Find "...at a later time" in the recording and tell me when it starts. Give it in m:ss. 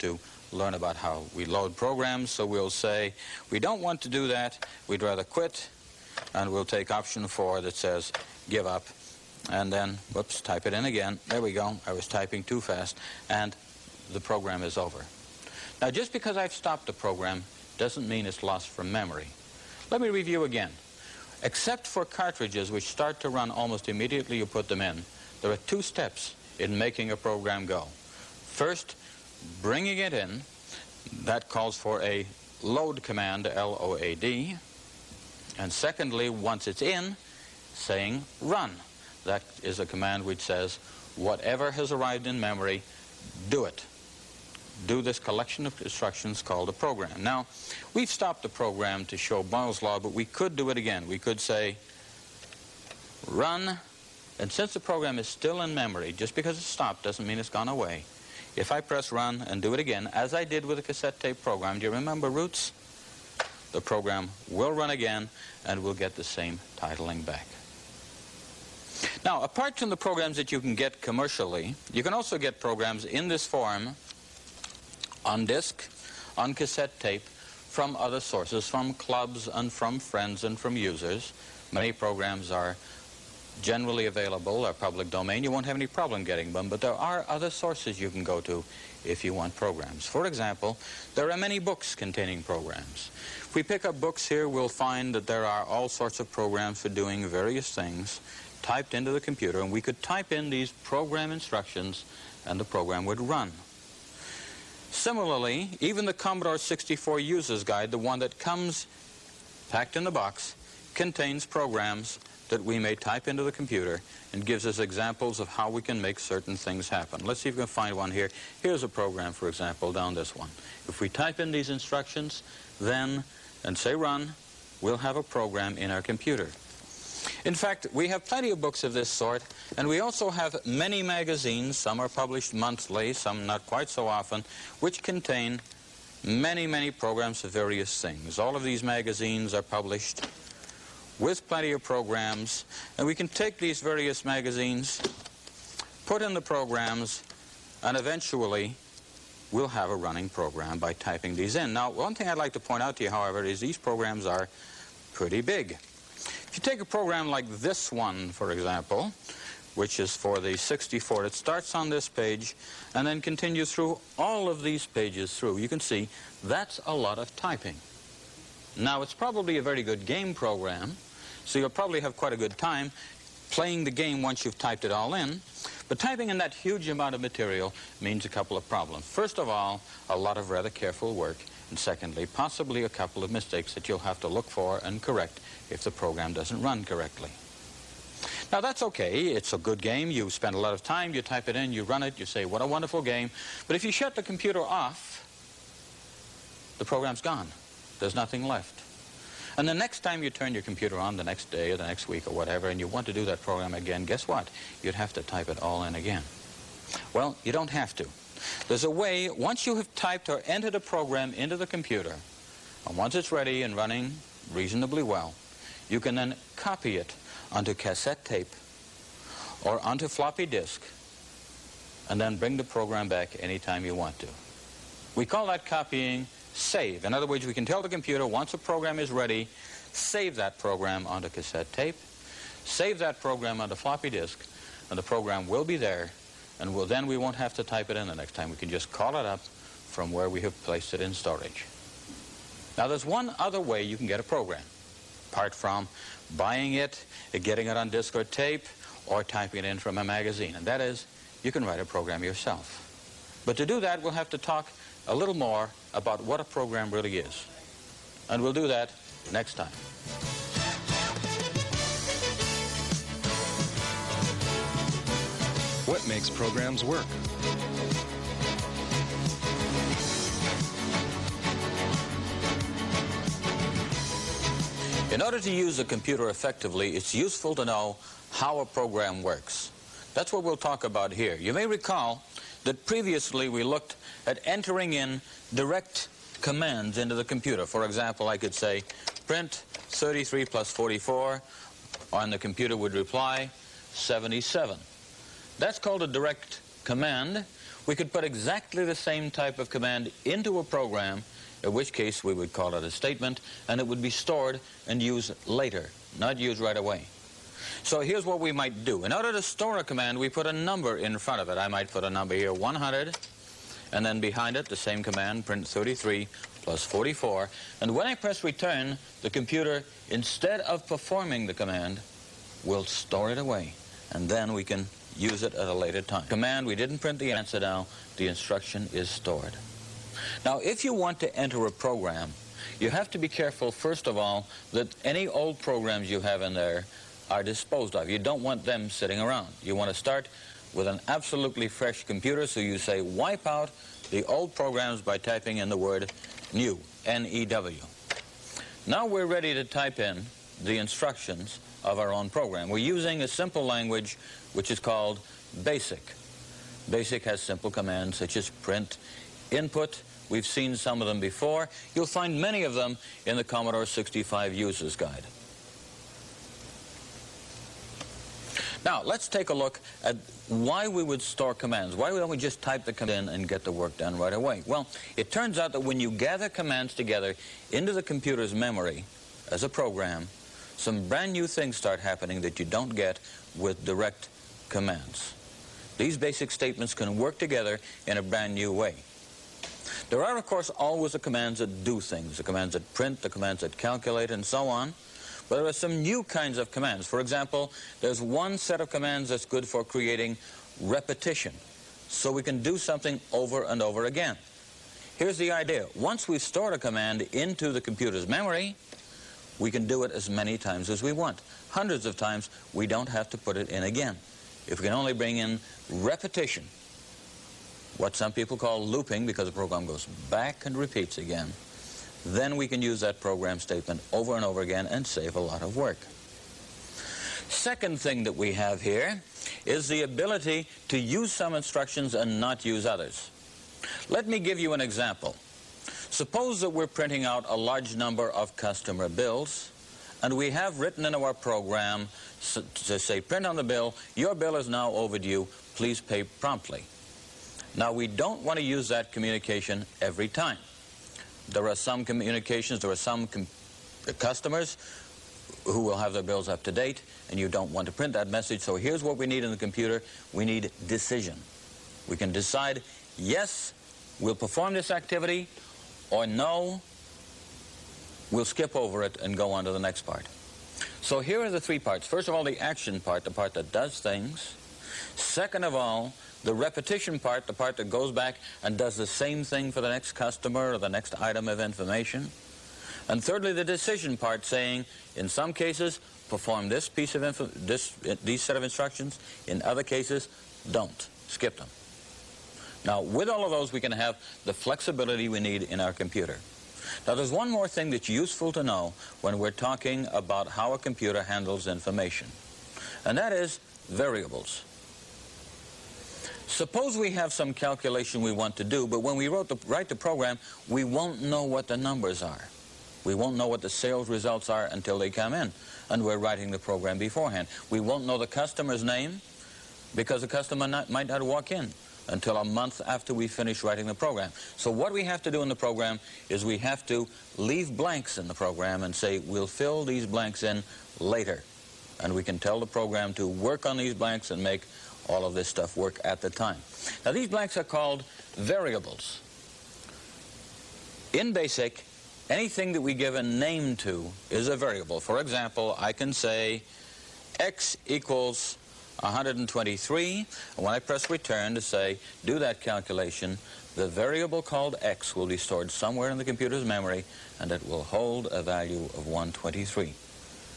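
5:25.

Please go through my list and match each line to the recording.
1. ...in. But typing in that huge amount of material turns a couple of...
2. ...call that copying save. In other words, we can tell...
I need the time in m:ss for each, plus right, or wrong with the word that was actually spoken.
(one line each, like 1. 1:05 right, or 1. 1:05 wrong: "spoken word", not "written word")
1. 2:55 wrong: "means", not "turns"
2. 3:45 right.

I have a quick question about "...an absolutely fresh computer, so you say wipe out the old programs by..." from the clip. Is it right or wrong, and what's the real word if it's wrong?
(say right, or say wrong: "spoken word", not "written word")
right.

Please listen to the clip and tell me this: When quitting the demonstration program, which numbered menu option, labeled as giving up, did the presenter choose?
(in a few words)
4.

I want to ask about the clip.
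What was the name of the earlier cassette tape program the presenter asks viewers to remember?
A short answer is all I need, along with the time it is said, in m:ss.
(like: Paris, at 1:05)
Roots, at 1:02.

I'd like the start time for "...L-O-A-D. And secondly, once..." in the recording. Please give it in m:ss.
0:33.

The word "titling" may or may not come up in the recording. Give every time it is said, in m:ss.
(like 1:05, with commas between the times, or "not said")
1:06.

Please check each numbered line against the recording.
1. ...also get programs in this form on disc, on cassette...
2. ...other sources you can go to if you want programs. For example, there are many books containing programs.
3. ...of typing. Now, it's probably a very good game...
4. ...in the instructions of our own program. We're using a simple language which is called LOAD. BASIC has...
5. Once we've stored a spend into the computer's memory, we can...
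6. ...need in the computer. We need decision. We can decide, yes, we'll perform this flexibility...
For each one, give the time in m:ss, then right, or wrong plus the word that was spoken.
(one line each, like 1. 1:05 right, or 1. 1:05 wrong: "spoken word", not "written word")
1. 1:12 right
2. 1:27 right
3. 2:47 right
4. 5:49 wrong: "BASIC", not "LOAD"
5. 6:45 wrong: "command", not "spend"
6. 7:39 wrong: "activity", not "flexibility".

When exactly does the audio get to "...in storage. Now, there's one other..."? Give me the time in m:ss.
4:01.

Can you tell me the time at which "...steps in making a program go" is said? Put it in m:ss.
0:25.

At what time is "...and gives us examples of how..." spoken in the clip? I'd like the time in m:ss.
1:54.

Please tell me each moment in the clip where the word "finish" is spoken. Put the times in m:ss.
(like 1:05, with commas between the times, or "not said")
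8:43.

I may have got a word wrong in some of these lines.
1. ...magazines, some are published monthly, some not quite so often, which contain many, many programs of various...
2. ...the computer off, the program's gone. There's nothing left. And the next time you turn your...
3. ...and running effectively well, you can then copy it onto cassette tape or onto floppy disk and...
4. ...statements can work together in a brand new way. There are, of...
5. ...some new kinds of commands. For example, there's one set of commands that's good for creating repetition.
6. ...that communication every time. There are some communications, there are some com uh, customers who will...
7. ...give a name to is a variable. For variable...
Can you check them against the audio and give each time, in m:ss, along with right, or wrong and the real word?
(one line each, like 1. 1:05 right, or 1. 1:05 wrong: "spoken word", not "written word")
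1. 2:11 right
2. 3:14 right
3. 3:33 wrong: "reasonably", not "effectively"
4. 6:26 right
5. 6:35 right
6. 7:28 right
7. 9:02 wrong: "example", not "variable".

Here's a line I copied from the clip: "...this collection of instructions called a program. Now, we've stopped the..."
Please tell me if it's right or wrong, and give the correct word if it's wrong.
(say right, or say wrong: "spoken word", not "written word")
right.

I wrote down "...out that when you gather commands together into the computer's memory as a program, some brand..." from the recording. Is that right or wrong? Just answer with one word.
right.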